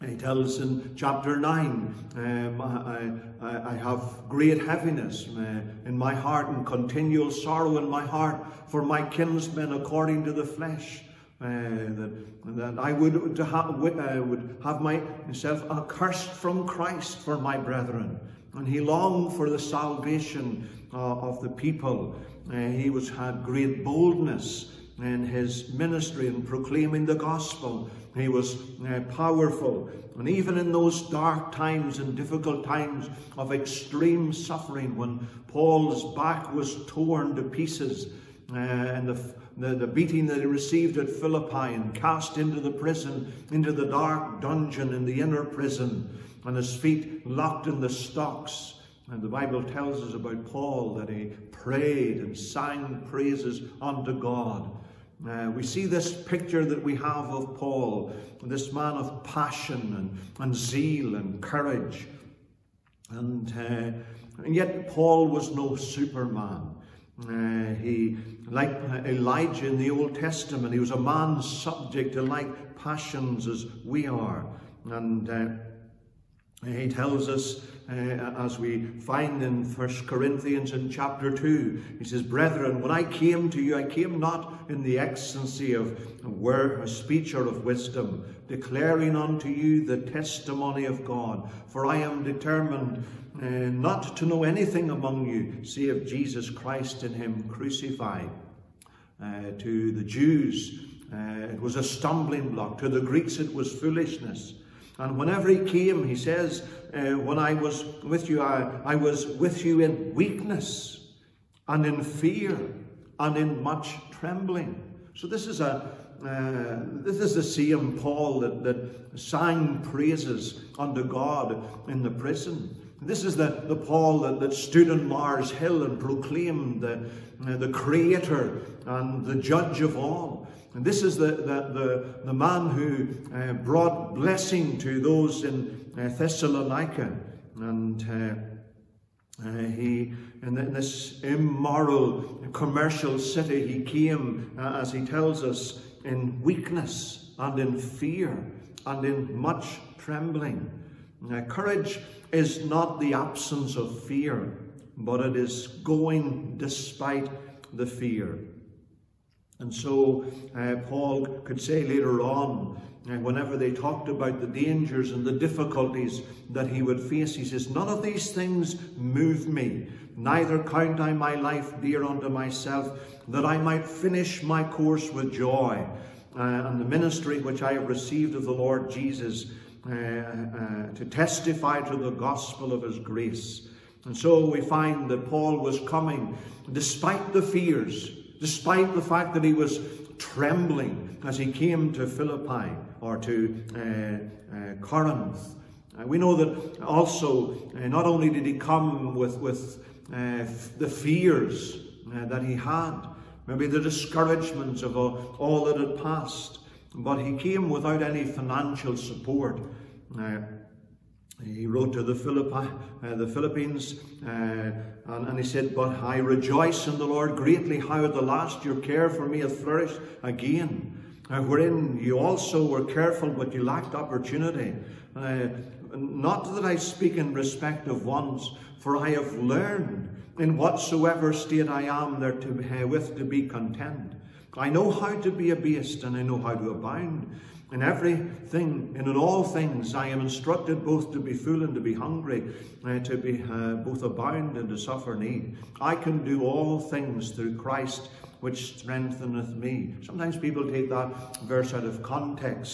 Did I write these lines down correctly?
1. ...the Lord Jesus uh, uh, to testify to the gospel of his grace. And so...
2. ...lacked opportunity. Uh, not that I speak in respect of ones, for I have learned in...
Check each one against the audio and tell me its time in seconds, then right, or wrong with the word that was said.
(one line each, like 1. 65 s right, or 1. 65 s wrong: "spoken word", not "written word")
1. 178 s right
2. 223 s right.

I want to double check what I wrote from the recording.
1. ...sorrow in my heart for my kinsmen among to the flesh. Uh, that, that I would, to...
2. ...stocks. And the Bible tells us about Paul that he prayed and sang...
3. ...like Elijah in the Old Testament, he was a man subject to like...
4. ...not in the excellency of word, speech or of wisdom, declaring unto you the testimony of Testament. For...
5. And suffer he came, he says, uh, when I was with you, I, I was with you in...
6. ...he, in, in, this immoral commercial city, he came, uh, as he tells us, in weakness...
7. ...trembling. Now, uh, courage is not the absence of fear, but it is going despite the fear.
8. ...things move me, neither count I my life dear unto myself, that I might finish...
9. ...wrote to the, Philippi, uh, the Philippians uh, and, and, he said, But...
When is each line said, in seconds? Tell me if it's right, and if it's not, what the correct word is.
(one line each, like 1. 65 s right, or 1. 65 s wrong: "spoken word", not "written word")
1. 7 s wrong: "according", not "among"
2. 47 s right
3. 68 s right
4. 84 s wrong: "God", not "Testament"
5. 104 s wrong: "whenever", not "suffer"
6. 139 s right
7. 149 s right
8. 168 s right
9. 211 s right.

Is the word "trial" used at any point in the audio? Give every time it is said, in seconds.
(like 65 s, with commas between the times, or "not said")
not said.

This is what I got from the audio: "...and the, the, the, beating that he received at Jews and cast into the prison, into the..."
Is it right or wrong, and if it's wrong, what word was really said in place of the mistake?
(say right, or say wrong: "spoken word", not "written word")
wrong: "Philippi", not "Jews".